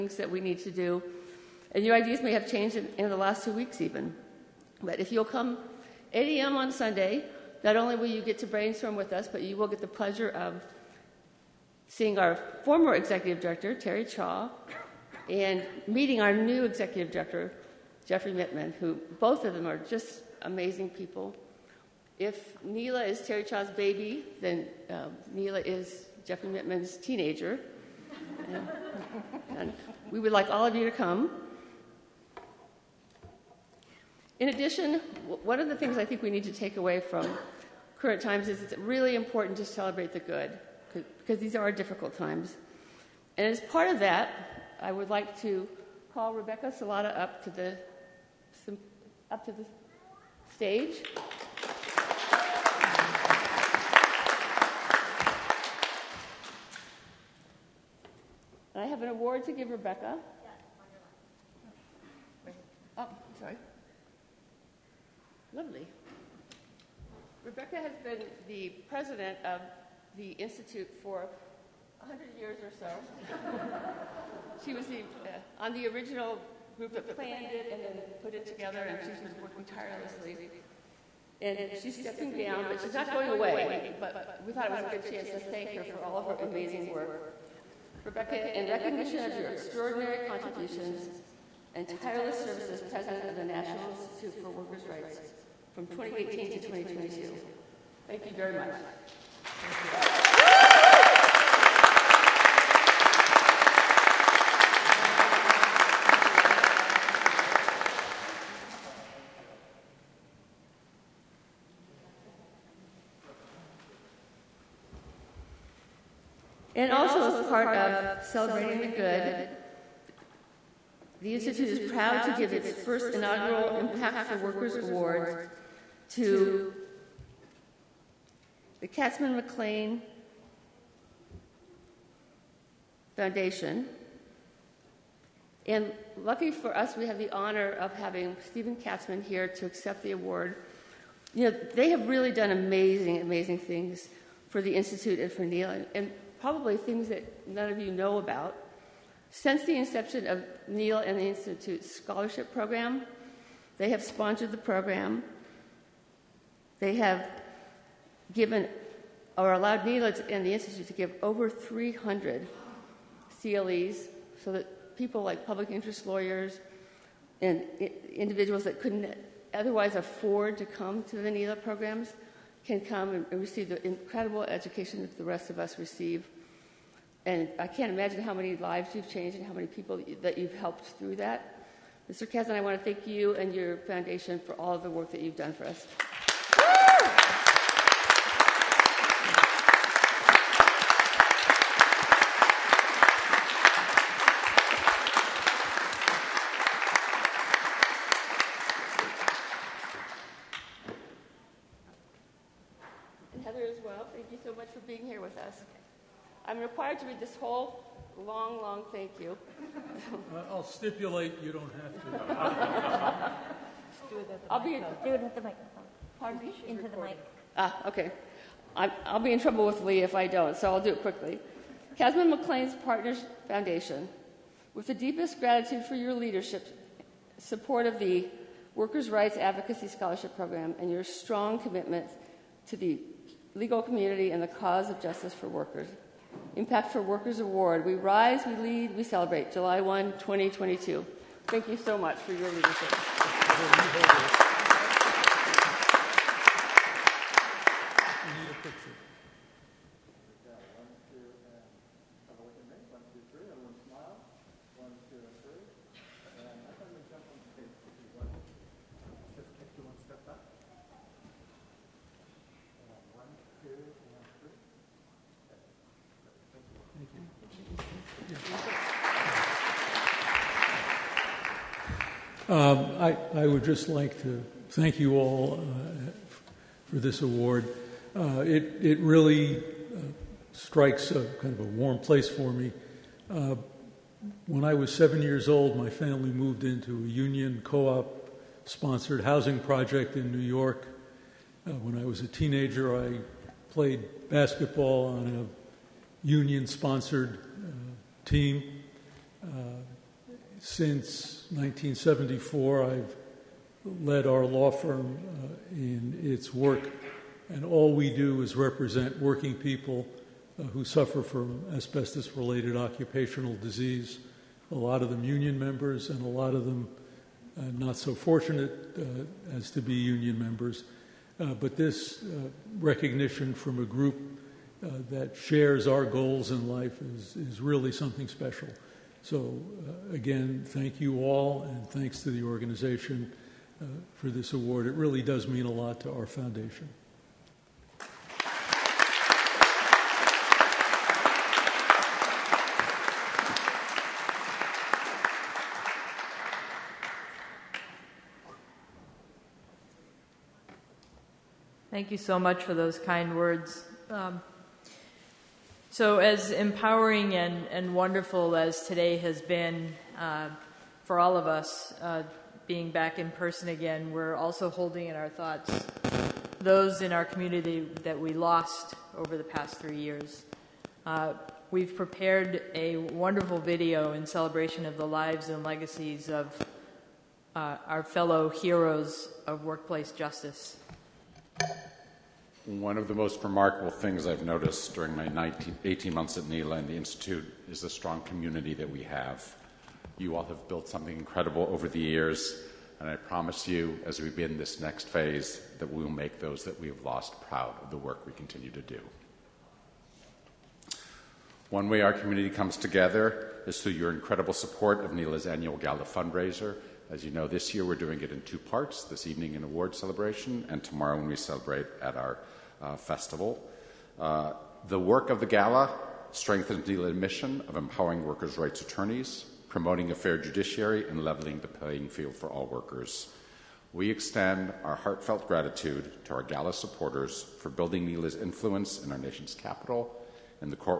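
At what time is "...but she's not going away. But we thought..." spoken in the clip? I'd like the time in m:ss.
1:22.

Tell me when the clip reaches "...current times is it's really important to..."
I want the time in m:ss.
0:37.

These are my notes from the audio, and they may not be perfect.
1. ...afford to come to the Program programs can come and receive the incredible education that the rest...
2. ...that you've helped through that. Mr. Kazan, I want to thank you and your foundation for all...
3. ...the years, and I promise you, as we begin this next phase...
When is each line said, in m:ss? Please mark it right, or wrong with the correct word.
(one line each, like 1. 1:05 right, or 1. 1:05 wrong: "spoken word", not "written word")
1. 2:49 wrong: "NELA", not "Program"
2. 3:00 right
3. 6:31 right.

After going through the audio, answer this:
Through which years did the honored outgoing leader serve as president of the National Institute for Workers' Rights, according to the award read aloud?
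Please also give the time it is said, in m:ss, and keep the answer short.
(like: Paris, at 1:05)
2018 to 2022, at 1:35.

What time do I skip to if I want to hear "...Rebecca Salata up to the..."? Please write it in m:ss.
0:46.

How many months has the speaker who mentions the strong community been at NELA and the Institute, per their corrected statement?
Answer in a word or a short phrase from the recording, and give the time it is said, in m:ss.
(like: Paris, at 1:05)
18, at 6:25.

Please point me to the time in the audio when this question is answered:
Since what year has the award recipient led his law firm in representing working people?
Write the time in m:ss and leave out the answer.
5:01.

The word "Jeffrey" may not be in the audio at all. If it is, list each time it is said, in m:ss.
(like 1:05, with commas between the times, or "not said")
0:18, 0:26.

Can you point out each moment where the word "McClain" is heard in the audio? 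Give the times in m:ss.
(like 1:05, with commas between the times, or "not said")
2:09, 3:42.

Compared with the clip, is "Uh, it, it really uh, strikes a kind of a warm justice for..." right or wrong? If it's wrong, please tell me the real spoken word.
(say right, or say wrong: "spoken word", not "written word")
wrong: "place", not "justice".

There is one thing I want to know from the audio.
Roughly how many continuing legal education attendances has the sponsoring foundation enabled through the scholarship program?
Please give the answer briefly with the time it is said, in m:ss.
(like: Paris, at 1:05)
over 300, at 2:41.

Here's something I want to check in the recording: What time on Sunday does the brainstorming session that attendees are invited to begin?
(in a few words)
8 a.m.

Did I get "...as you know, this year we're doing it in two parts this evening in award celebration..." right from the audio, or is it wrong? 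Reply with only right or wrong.
right.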